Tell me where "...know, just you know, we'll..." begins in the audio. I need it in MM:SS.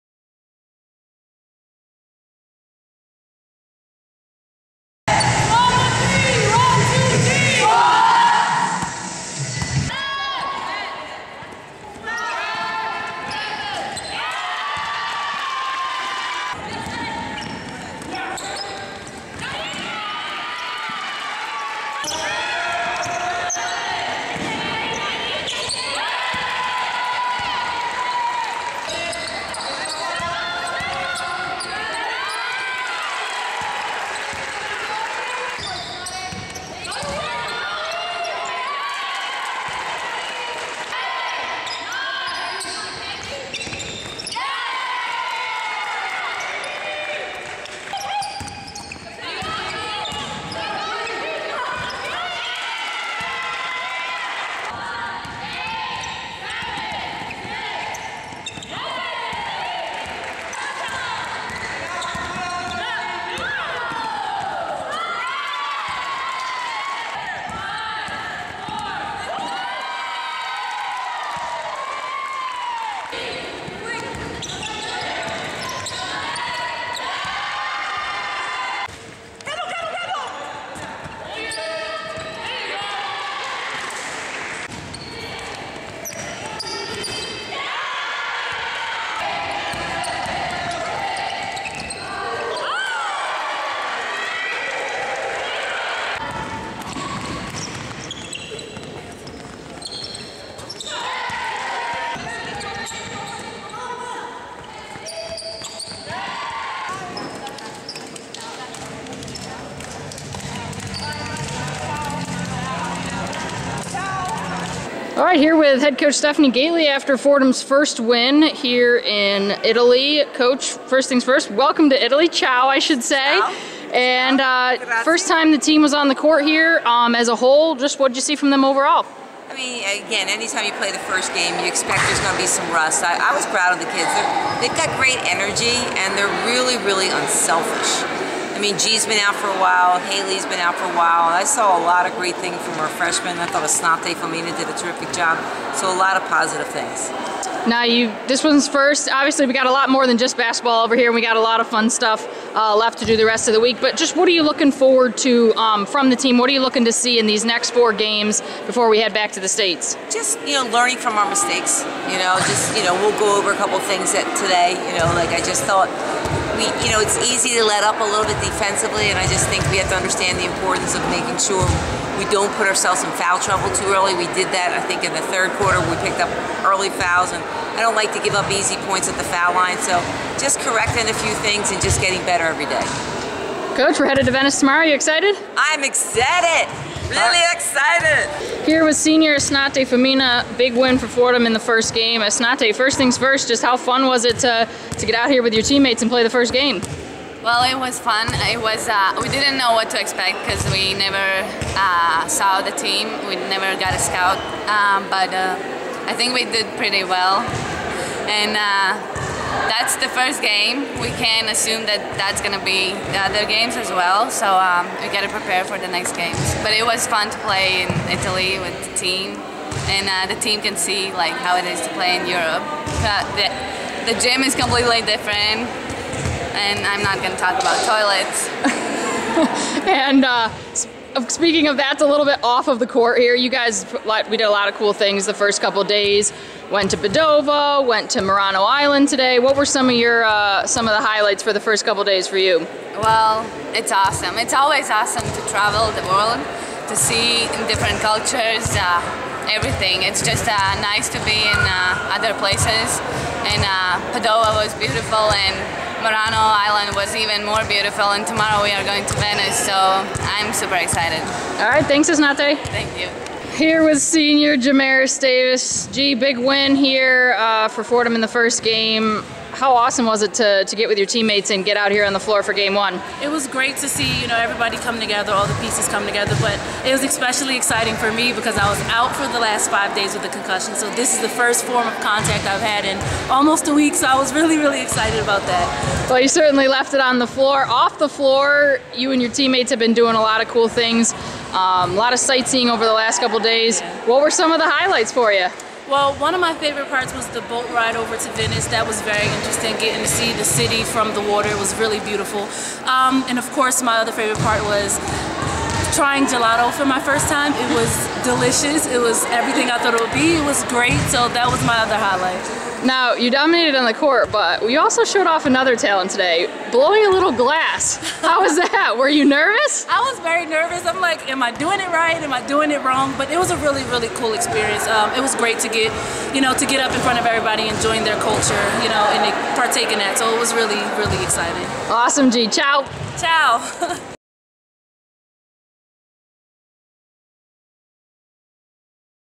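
02:42.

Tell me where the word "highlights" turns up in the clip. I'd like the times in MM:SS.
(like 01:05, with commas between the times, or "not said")
04:01, 04:54, 05:11.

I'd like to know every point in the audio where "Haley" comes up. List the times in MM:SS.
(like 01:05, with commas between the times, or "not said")
02:19.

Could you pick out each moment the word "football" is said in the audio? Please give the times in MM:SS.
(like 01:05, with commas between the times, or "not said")
not said.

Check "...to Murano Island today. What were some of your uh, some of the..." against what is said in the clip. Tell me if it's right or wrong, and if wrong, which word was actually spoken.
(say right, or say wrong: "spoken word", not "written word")
right.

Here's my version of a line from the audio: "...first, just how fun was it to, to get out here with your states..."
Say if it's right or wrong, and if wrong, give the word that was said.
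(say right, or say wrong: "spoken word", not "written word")
wrong: "teammates", not "states".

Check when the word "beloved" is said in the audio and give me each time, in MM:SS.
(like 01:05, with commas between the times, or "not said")
not said.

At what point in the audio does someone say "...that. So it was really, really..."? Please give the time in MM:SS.
05:29.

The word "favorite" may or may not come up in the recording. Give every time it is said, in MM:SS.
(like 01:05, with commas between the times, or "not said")
04:56, 05:04.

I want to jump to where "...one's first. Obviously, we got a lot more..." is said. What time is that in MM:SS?
02:28.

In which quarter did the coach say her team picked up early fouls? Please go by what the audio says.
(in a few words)
third.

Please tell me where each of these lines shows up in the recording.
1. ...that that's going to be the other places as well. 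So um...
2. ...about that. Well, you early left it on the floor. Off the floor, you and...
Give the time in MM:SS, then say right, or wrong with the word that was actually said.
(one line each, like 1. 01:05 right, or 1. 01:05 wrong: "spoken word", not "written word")
1. 03:31 wrong: "games", not "places"
2. 04:45 wrong: "certainly", not "early".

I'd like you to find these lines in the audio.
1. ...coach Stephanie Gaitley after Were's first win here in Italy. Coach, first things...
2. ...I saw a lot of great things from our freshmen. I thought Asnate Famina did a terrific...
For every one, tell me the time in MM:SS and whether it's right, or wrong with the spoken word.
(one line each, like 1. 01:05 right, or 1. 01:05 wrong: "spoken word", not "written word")
1. 01:55 wrong: "Fordham", not "Were"
2. 02:21 right.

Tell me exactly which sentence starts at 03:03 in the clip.
Coach, we're headed to Venice tomorrow.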